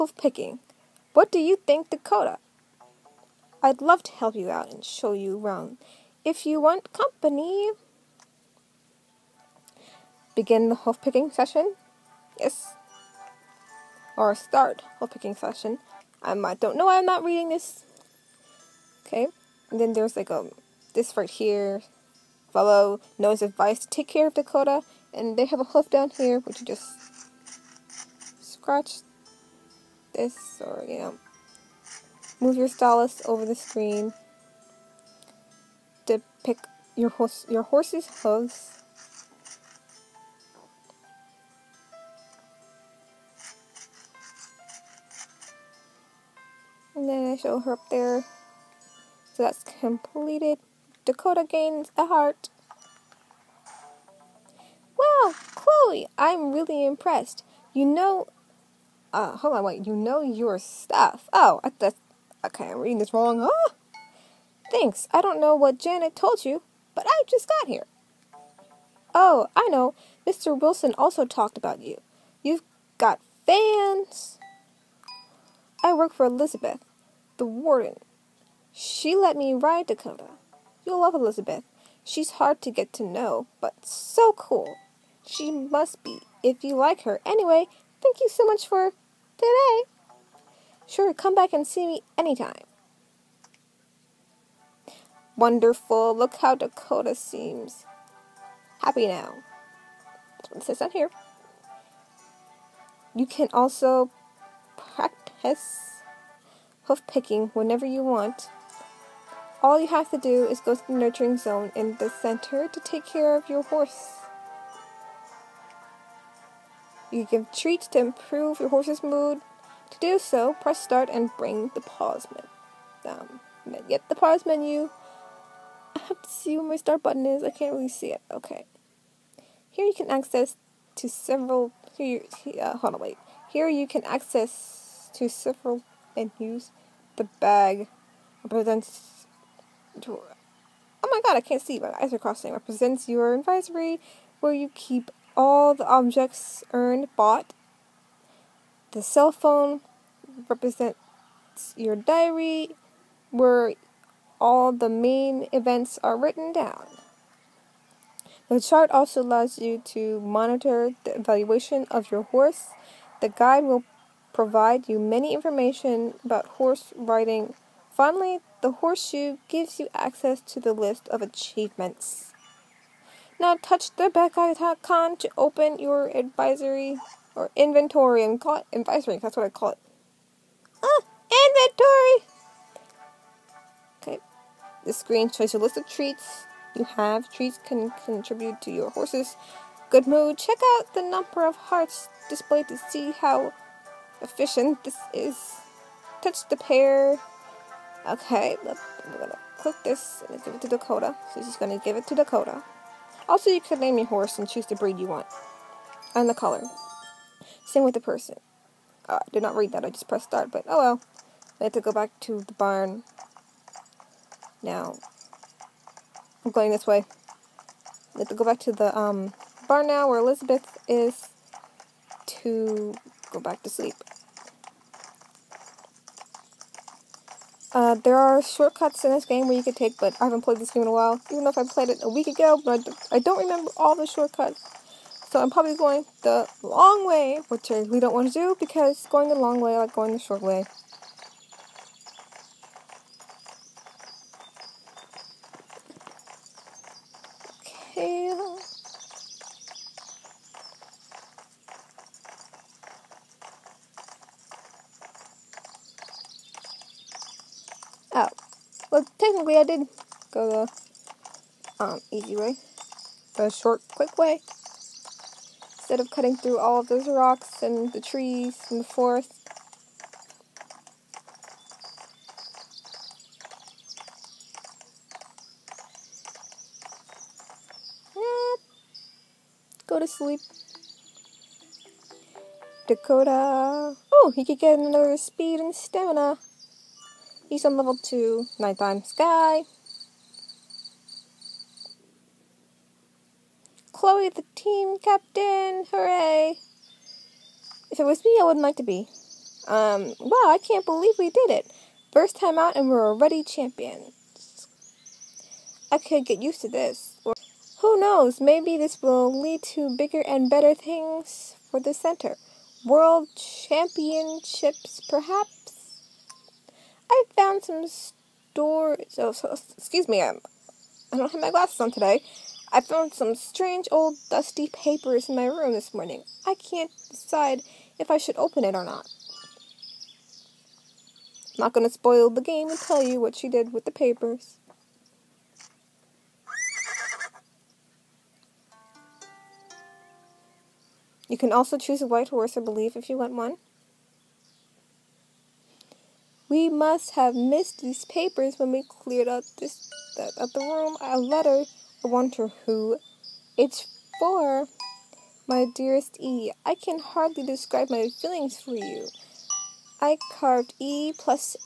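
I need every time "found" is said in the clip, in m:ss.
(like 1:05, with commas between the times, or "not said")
5:17, 5:22.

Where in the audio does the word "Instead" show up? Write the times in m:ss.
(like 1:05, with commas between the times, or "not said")
4:25.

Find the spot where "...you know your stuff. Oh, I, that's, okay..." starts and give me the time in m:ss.
0:59.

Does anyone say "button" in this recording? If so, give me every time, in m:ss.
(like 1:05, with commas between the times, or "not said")
2:07.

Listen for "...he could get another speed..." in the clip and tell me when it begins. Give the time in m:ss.
4:44.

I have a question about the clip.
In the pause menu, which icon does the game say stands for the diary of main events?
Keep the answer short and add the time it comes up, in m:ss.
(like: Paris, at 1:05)
The cell phone, at 2:28.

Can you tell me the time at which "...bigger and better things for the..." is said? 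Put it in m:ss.
5:09.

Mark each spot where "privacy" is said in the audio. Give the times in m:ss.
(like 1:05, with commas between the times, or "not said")
not said.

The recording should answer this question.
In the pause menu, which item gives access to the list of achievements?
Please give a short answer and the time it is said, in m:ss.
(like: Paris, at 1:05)
The horseshoe, at 2:48.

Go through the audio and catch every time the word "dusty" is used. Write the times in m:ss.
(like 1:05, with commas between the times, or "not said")
5:24.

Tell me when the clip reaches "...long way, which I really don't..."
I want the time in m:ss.
3:56.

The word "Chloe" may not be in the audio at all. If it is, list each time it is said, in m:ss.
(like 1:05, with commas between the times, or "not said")
0:55, 4:53.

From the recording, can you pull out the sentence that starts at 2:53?
Now touch the back icon to open your advisory or inventory and call it advisory, that's what I call it.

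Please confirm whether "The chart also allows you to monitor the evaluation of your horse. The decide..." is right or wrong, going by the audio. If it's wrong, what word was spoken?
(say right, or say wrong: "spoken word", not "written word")
wrong: "guide", not "decide".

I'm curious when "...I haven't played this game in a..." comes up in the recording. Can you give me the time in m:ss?
3:50.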